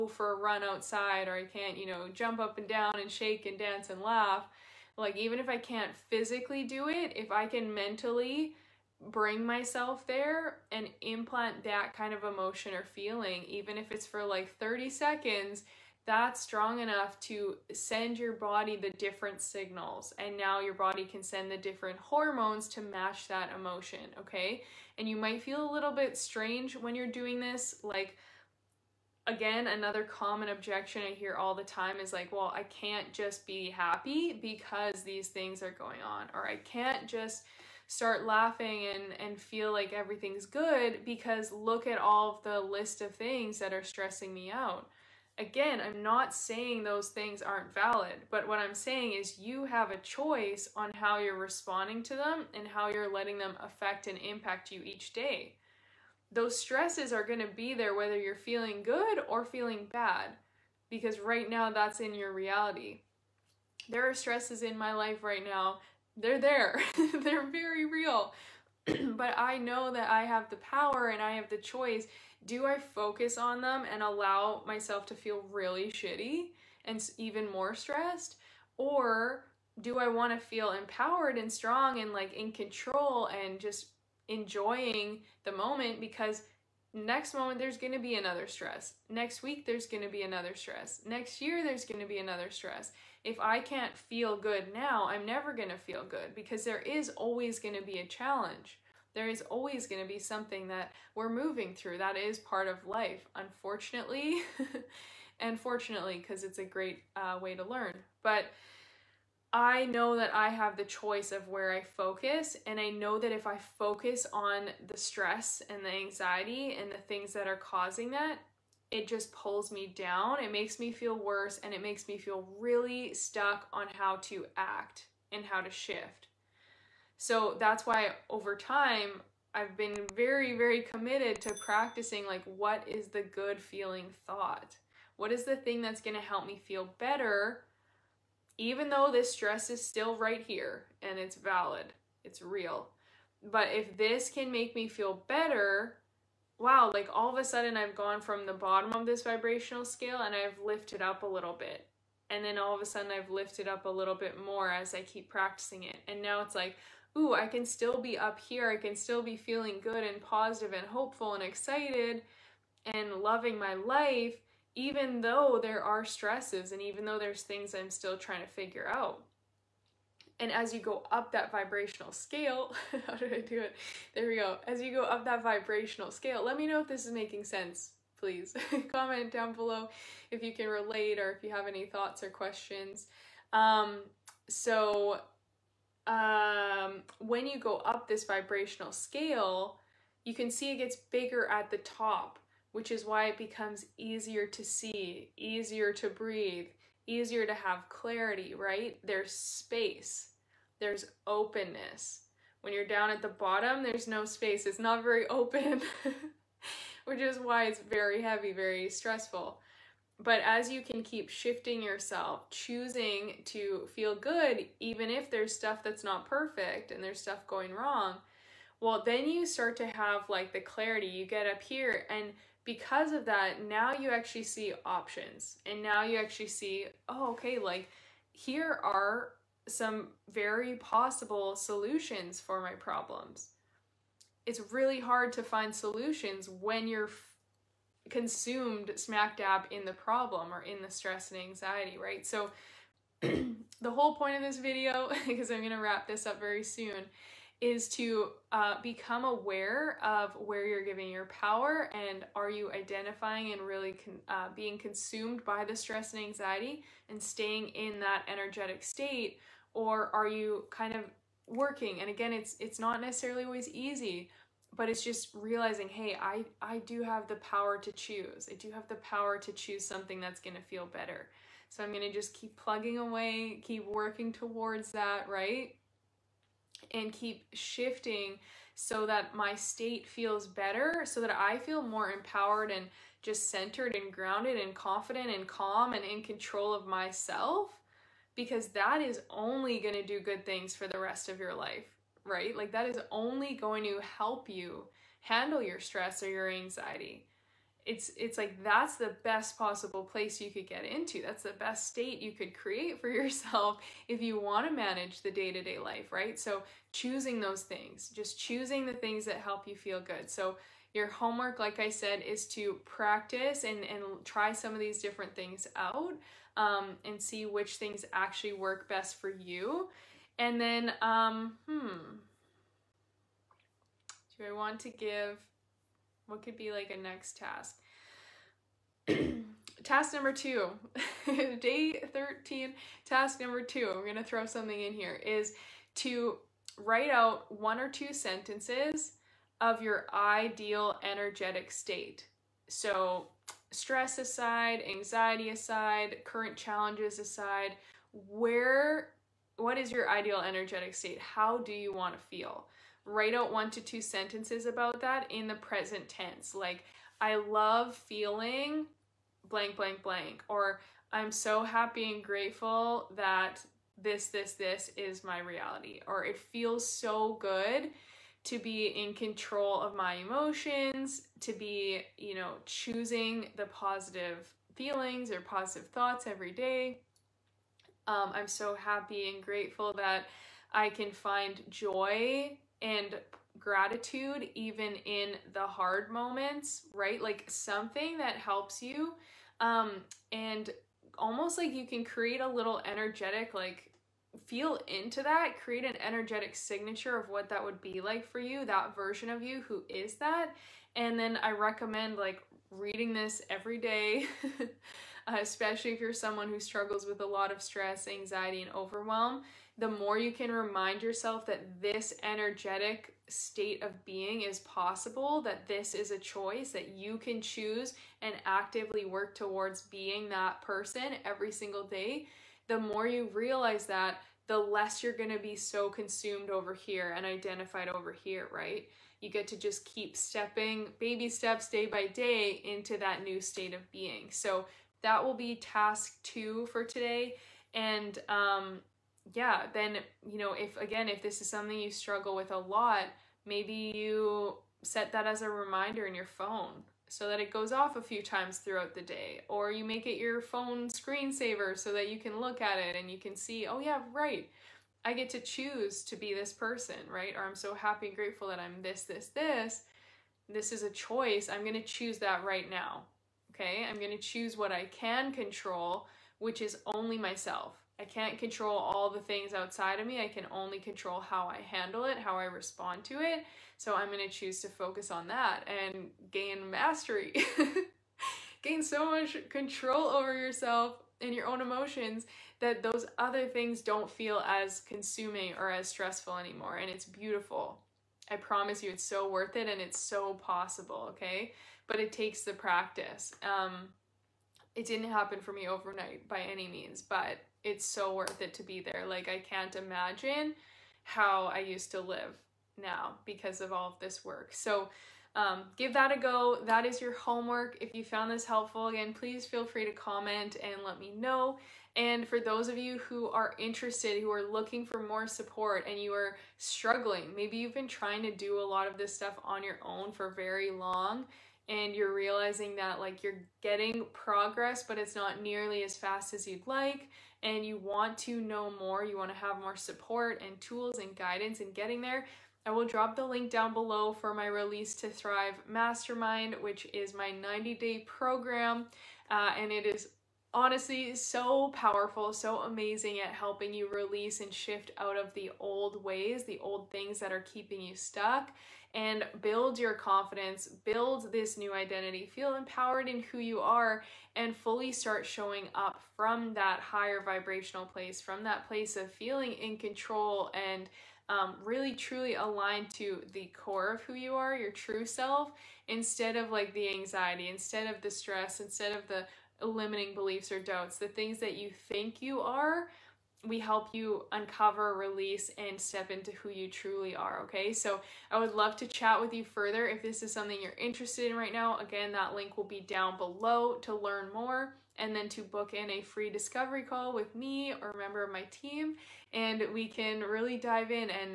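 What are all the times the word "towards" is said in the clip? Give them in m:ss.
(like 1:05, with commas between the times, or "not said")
4:34, 6:59.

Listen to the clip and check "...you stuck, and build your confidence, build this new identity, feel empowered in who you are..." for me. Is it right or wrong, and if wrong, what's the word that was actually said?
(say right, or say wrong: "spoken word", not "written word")
right.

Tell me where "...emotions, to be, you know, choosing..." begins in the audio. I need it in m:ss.
6:10.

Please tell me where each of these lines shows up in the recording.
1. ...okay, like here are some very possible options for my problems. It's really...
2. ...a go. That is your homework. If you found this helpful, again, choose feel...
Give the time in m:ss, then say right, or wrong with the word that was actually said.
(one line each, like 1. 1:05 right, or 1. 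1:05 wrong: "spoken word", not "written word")
1. 3:47 wrong: "solutions", not "options"
2. 8:26 wrong: "please", not "choose".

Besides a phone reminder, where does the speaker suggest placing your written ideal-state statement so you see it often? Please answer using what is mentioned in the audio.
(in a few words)
phone screensaver.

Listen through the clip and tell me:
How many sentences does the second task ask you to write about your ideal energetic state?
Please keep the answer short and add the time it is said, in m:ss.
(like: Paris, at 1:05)
one or two, at 5:37.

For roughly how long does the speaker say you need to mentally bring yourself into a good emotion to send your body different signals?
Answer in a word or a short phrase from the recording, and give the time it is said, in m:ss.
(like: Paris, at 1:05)
30 seconds, at 0:14.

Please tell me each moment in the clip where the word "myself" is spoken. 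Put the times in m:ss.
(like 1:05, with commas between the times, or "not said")
0:09, 1:14, 4:46, 7:47.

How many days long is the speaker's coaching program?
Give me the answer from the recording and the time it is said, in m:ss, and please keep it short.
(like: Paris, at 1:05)
90, at 8:57.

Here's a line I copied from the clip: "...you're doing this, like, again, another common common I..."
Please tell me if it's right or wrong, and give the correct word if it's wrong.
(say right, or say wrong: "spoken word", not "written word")
wrong: "objection", not "common".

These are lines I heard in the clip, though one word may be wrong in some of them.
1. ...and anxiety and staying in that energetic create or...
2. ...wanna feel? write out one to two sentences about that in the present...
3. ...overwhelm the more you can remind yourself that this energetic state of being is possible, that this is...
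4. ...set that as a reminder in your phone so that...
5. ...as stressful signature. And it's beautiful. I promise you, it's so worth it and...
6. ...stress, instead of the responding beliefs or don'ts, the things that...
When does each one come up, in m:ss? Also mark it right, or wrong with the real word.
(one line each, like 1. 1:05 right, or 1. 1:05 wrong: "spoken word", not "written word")
1. 4:16 wrong: "state", not "create"
2. 5:51 right
3. 6:48 right
4. 7:24 right
5. 8:05 wrong: "anymore", not "signature"
6. 9:28 wrong: "limiting", not "responding".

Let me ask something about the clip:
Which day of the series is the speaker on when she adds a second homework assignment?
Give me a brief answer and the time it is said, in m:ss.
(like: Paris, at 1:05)
13, at 5:31.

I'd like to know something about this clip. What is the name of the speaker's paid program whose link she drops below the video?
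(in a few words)
Release to Thrive Mastermind.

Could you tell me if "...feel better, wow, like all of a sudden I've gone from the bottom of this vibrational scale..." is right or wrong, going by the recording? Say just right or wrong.
right.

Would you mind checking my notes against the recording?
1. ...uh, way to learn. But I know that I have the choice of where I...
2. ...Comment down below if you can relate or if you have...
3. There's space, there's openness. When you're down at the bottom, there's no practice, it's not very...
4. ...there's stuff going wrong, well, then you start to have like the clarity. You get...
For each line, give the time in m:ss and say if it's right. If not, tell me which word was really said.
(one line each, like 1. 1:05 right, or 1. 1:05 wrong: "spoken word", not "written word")
1. 1:47 right
2. 2:58 right
3. 3:19 wrong: "space", not "practice"
4. 3:37 right.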